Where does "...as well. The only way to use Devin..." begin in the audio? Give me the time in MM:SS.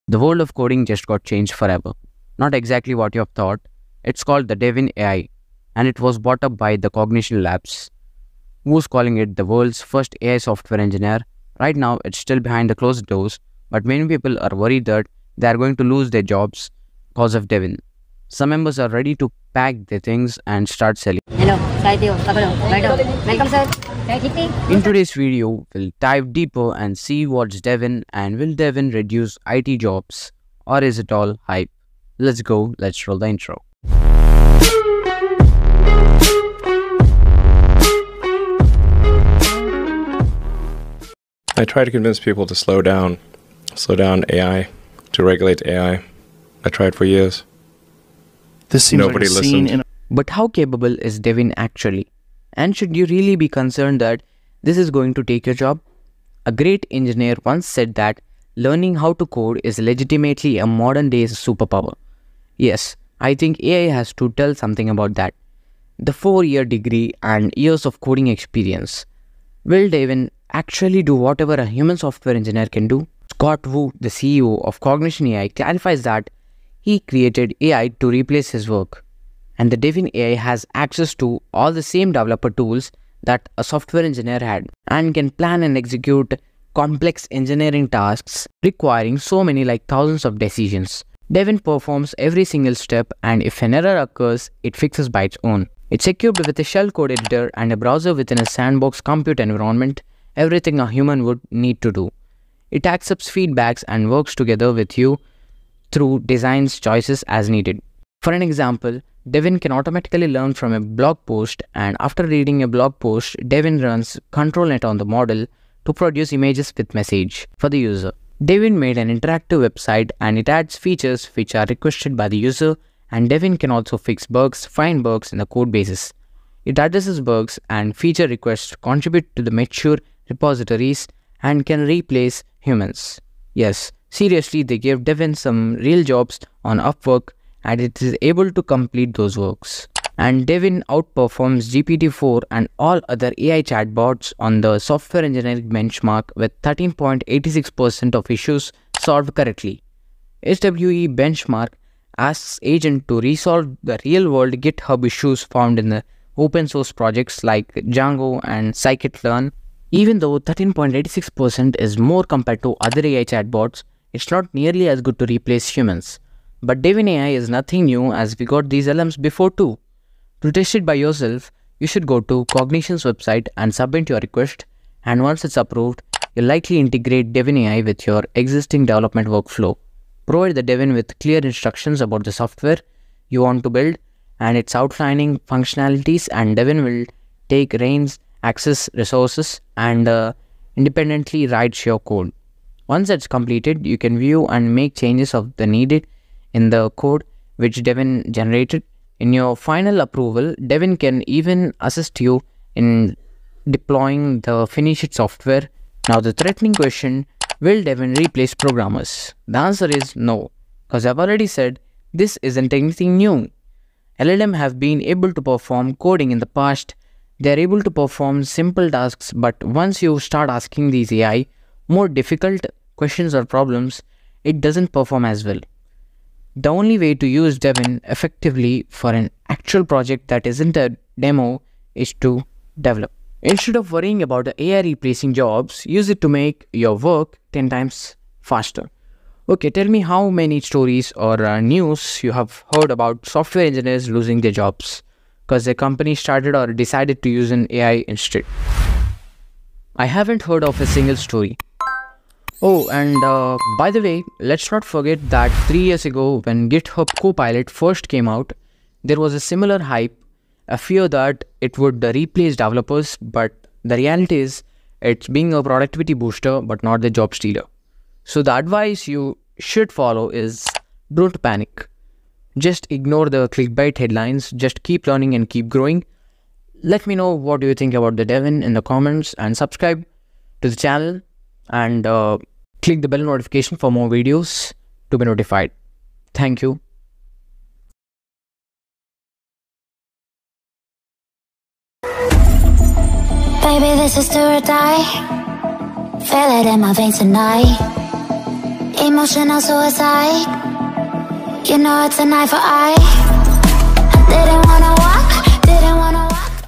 03:45.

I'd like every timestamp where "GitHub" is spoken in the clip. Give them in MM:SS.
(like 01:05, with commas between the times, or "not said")
02:34, 04:16.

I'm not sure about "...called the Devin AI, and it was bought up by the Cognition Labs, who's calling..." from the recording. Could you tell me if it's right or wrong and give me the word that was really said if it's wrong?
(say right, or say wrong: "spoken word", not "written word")
right.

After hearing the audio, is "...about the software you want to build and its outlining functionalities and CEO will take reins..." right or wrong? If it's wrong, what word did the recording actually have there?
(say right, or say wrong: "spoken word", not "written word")
wrong: "Devin", not "CEO".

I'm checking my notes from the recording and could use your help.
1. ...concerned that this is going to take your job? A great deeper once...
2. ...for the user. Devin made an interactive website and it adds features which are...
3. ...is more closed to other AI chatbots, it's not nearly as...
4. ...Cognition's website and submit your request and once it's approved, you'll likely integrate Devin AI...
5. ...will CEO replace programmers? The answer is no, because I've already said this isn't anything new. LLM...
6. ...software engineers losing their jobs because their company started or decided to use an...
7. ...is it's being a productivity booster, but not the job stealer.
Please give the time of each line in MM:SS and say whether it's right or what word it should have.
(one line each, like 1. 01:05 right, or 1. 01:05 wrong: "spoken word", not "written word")
1. 00:53 wrong: "engineer", not "deeper"
2. 01:57 right
3. 02:41 wrong: "compared", not "closed"
4. 02:52 right
5. 03:27 wrong: "Devin", not "CEO"
6. 04:03 right
7. 04:24 right.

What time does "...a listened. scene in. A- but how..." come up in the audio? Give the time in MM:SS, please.
00:49.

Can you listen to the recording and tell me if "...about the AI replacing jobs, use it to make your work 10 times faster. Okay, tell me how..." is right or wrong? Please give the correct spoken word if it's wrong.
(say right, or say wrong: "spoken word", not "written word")
right.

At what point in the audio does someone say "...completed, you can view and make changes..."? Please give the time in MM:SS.
03:13.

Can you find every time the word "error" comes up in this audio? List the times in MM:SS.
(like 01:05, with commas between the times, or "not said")
01:33.